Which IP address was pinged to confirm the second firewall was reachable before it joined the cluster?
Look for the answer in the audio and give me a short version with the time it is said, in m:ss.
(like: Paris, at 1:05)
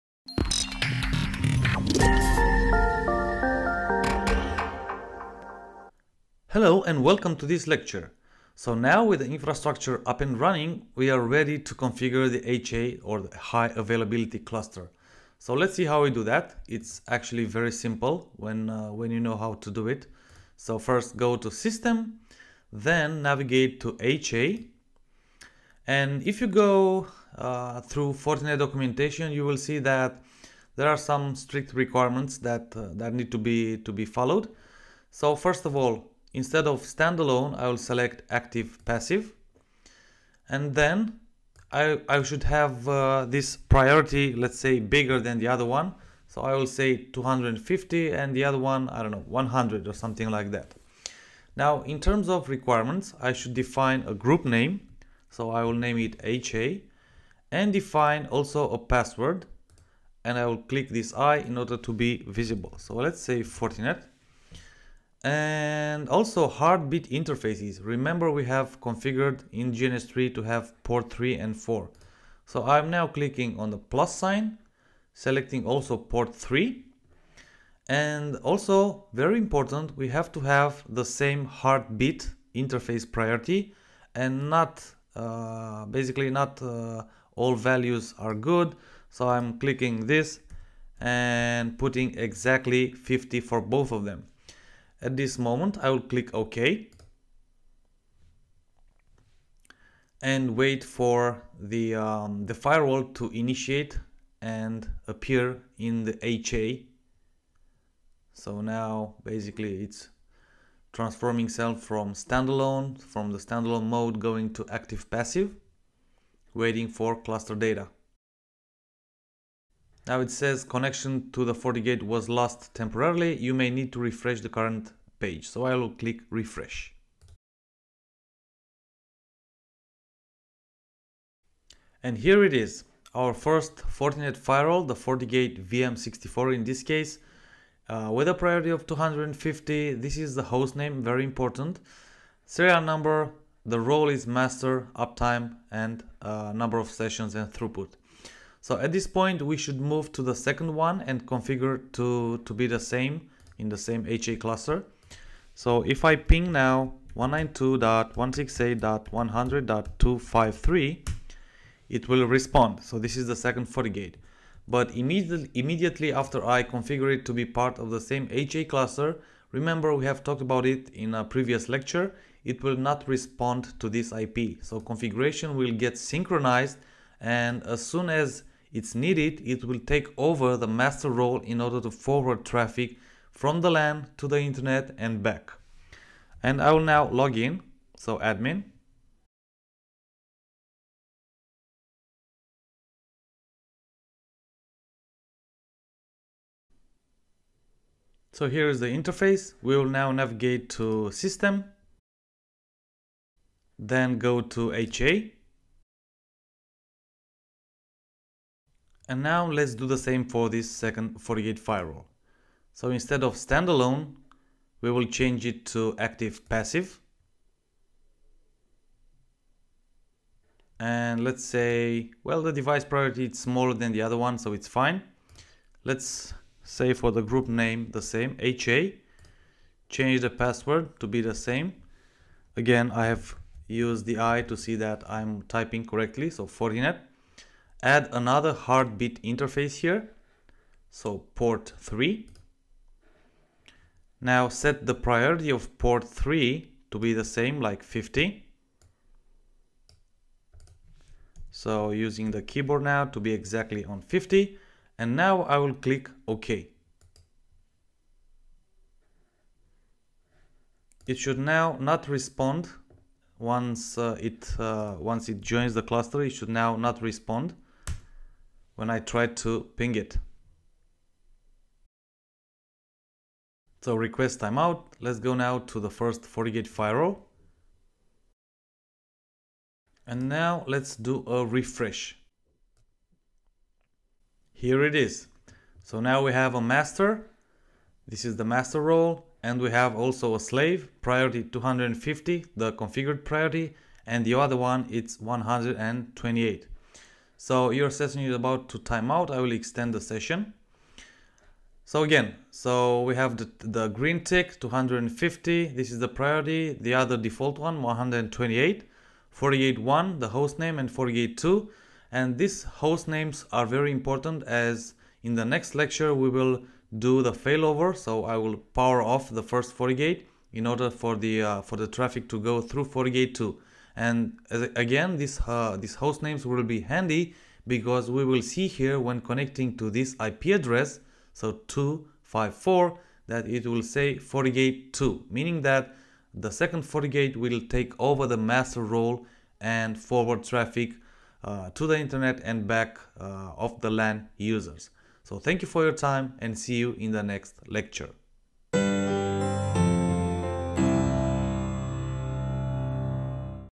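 192.168.100.253, at 2:37.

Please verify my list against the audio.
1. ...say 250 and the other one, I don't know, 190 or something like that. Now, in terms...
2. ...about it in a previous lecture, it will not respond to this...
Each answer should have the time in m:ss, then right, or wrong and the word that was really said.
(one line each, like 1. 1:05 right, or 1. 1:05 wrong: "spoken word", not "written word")
1. 0:46 wrong: "100", not "190"
2. 2:50 right.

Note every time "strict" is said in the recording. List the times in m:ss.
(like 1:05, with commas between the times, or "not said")
0:31.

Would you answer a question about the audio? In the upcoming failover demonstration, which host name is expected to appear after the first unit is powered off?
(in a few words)
FortiGate 2.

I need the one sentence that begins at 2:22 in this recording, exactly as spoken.
Serial number, the role is master, uptime, and uh, number of sessions and throughput.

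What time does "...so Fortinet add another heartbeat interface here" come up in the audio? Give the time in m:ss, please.
3:56.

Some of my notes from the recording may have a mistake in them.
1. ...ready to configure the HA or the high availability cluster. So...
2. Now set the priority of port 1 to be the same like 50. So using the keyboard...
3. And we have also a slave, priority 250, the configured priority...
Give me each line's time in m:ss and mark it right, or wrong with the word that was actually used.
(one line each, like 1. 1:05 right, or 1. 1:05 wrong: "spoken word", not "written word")
1. 0:11 right
2. 4:04 wrong: "3", not "1"
3. 4:49 right.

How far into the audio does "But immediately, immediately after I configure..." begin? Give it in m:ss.
2:44.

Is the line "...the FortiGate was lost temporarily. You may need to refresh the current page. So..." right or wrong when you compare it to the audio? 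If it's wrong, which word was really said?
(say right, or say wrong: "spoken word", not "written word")
right.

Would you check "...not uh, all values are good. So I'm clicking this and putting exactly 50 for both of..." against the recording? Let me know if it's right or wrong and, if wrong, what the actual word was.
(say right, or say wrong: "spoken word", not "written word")
right.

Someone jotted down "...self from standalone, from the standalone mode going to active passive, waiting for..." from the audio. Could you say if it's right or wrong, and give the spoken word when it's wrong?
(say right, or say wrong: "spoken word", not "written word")
right.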